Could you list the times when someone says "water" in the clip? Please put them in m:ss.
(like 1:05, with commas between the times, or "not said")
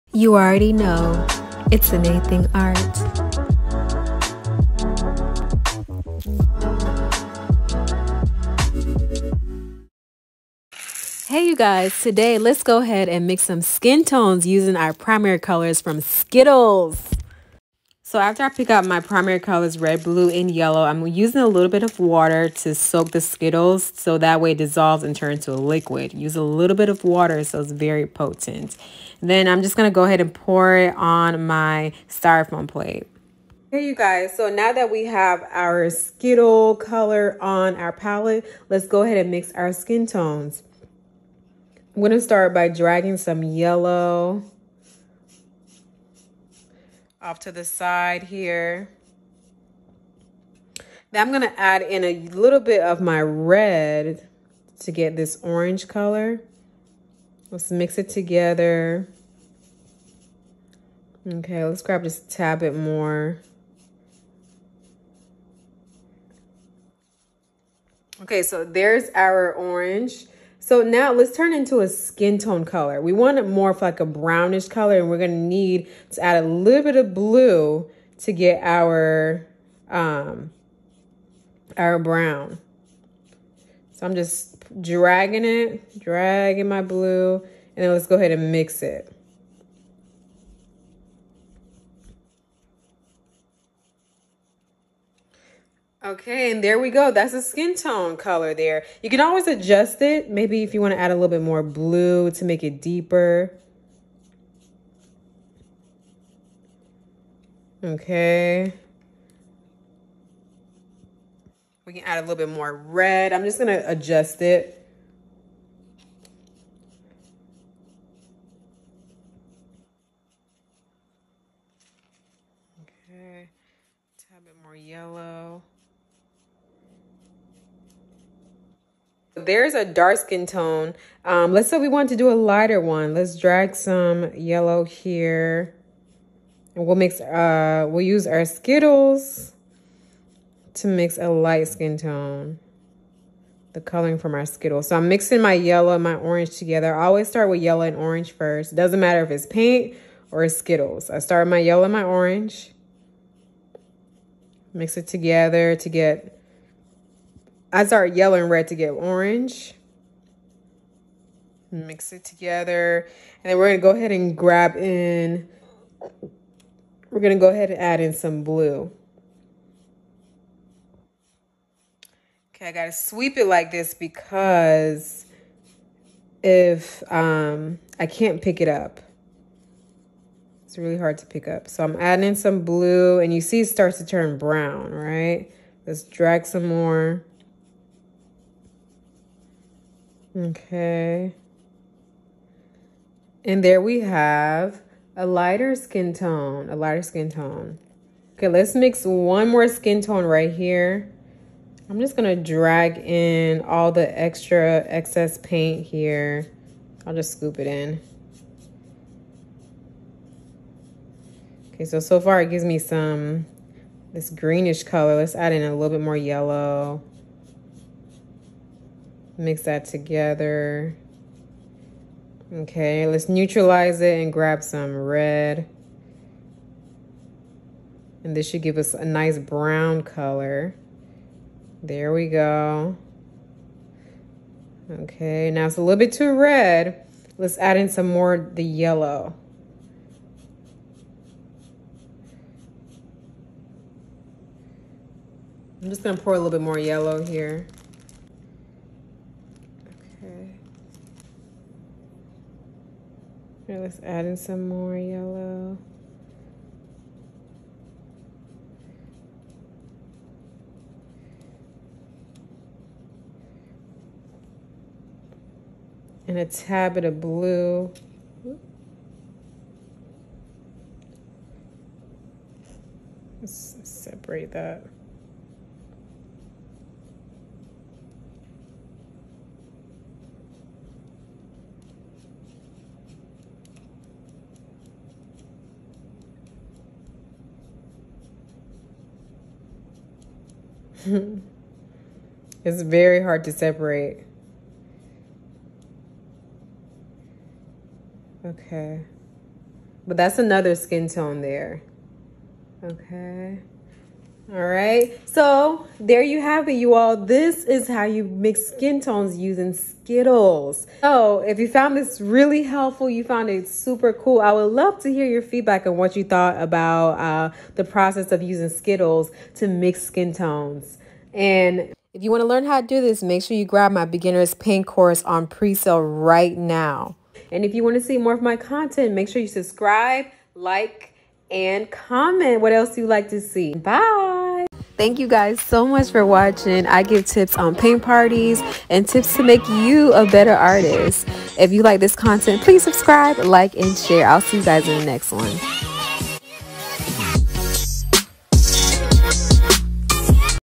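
0:21, 0:27.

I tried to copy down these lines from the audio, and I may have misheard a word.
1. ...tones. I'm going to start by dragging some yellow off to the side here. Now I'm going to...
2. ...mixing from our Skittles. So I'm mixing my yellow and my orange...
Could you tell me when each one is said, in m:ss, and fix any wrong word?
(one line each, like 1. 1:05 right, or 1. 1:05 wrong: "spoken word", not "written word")
1. 0:40 right
2. 2:23 wrong: "coloring", not "mixing".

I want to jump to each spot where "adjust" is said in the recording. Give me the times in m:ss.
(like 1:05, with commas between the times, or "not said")
1:39, 1:53.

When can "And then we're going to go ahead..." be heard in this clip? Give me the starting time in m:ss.
2:43.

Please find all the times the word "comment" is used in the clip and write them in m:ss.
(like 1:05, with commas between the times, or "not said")
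5:31.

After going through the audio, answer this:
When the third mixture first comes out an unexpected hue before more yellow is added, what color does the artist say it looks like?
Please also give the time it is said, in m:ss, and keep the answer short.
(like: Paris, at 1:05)
Greenish, at 3:34.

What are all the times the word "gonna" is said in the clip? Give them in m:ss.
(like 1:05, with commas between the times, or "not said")
1:15, 3:22, 4:06.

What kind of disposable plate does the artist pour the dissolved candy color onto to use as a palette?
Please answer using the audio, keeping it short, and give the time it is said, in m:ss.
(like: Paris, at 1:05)
Styrofoam plate, at 0:32.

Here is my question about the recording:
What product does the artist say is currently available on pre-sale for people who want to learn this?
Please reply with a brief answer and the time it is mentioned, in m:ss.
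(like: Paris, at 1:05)
Beginner's paint course, at 5:24.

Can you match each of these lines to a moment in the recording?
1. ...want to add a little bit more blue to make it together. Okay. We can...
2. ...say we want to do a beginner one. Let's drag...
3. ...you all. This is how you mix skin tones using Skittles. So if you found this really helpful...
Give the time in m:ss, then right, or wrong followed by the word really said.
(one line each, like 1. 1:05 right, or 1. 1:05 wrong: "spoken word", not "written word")
1. 1:40 wrong: "deeper", not "together"
2. 2:11 wrong: "lighter", not "beginner"
3. 5:06 right.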